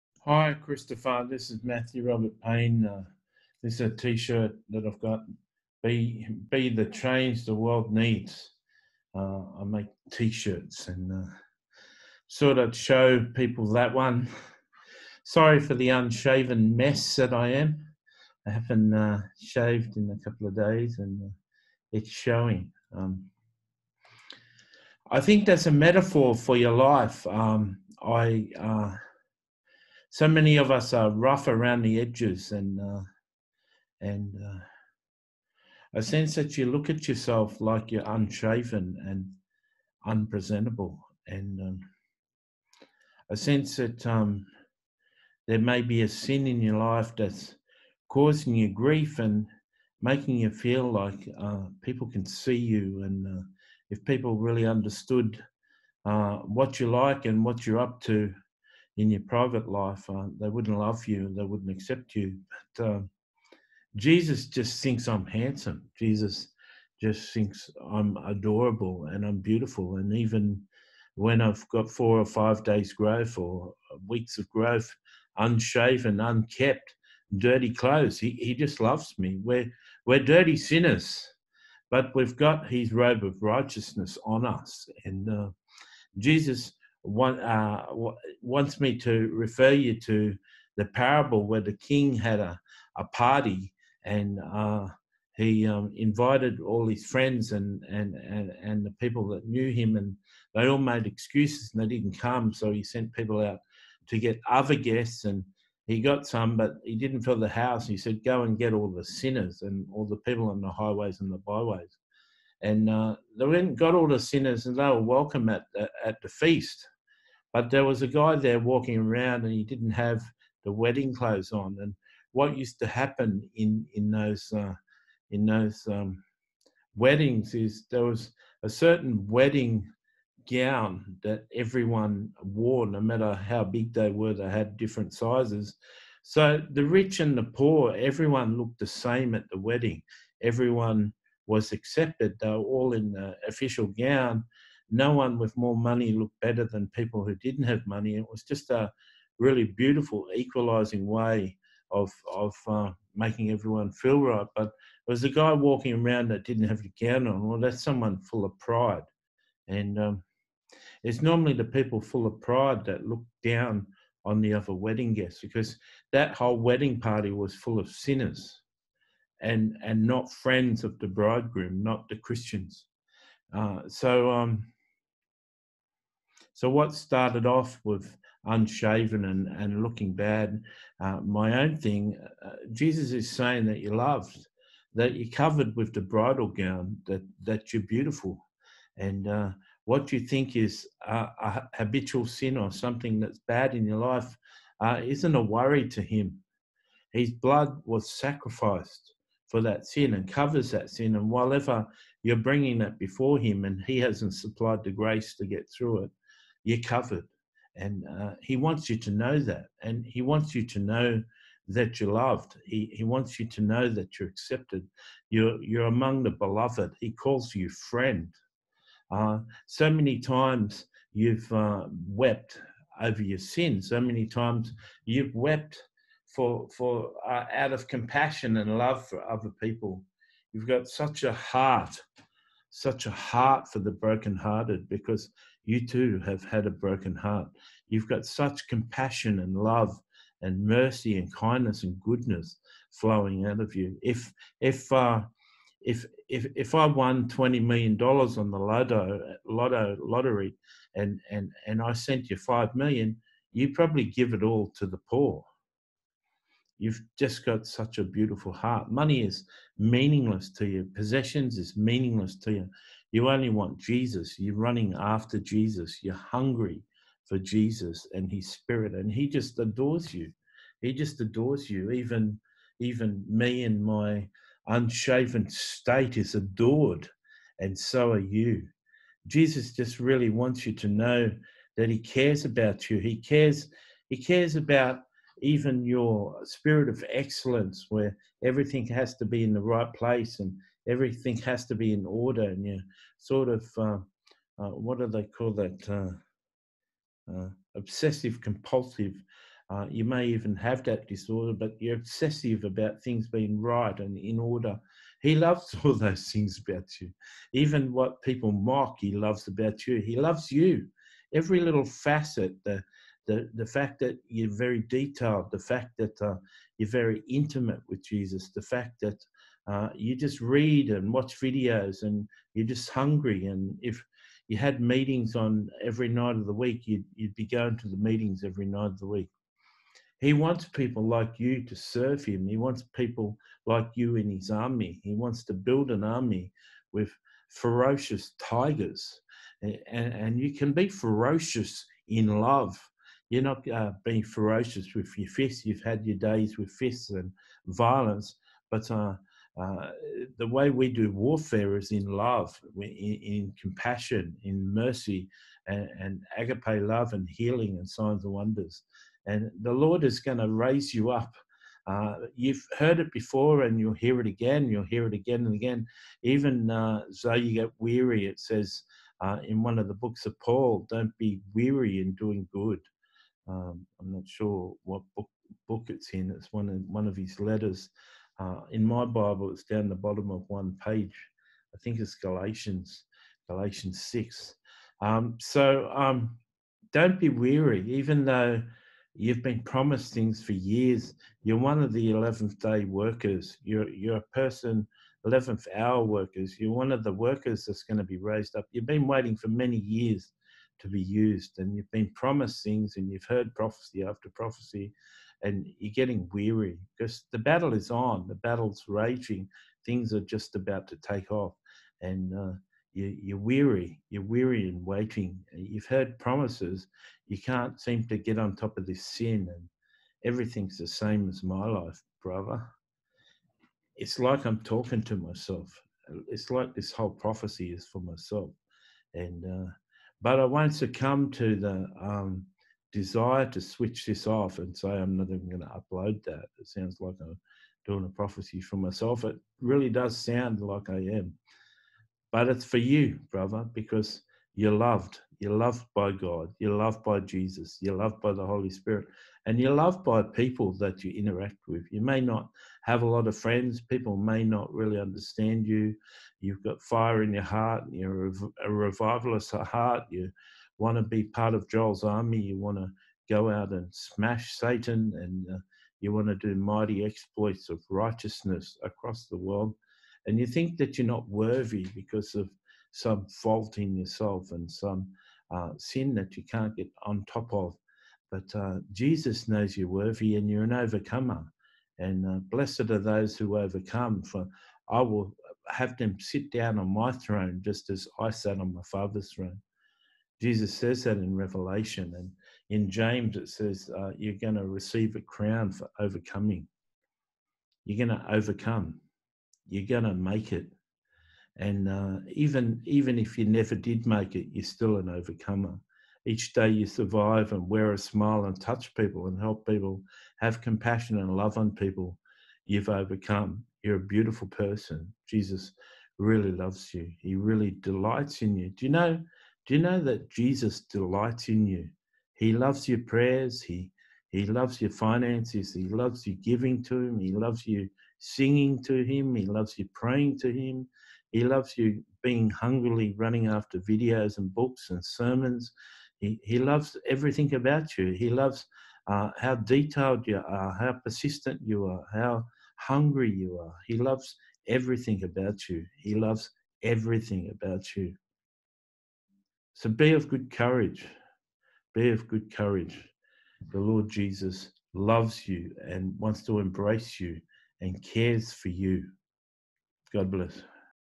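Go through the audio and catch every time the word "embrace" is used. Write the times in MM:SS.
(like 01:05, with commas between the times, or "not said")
09:16.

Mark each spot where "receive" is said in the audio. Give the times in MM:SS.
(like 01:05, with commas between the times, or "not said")
08:14.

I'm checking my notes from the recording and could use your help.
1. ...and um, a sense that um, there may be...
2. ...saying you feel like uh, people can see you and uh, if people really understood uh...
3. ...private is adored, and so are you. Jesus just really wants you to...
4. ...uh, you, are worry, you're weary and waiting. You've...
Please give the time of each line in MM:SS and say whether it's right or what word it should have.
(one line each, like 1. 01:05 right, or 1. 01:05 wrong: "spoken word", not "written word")
1. 00:41 right
2. 00:50 wrong: "making", not "saying"
3. 04:35 wrong: "state", not "private"
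4. 06:52 wrong: "weary", not "worry".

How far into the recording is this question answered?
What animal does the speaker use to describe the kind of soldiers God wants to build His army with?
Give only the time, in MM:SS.
05:38.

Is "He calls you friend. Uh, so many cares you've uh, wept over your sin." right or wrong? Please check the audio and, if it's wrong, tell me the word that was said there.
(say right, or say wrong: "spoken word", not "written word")
wrong: "times", not "cares".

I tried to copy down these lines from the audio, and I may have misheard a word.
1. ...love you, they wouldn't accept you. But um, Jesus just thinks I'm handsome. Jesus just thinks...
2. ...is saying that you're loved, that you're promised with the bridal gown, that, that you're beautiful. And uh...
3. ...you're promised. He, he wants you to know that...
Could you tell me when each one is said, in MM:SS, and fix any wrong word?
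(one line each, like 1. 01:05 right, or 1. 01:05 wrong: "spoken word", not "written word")
1. 01:00 right
2. 03:03 wrong: "covered", not "promised"
3. 03:31 wrong: "loved", not "promised".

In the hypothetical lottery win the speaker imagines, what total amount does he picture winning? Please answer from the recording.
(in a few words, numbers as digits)
$20 million.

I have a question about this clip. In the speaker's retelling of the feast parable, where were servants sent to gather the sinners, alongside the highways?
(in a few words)
the byways.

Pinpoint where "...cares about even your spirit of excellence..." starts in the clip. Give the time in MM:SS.
04:44.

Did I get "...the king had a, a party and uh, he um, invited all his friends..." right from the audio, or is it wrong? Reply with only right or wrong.
right.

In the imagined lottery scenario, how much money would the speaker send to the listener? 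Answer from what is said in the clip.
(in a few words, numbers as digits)
$5 million.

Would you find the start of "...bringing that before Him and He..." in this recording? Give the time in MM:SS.
03:22.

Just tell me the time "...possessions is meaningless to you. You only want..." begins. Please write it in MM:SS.
04:20.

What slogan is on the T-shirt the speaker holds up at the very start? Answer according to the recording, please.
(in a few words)
Be the change the world needs.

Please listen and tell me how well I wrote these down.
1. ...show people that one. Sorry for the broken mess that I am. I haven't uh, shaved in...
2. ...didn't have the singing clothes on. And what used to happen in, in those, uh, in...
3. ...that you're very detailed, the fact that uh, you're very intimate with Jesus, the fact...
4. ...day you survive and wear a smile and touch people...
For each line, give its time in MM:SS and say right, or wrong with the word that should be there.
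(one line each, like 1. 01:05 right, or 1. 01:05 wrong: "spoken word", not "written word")
1. 00:12 wrong: "unshaven", not "broken"
2. 01:59 wrong: "wedding", not "singing"
3. 05:13 right
4. 08:26 right.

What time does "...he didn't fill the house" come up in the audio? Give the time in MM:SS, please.
01:46.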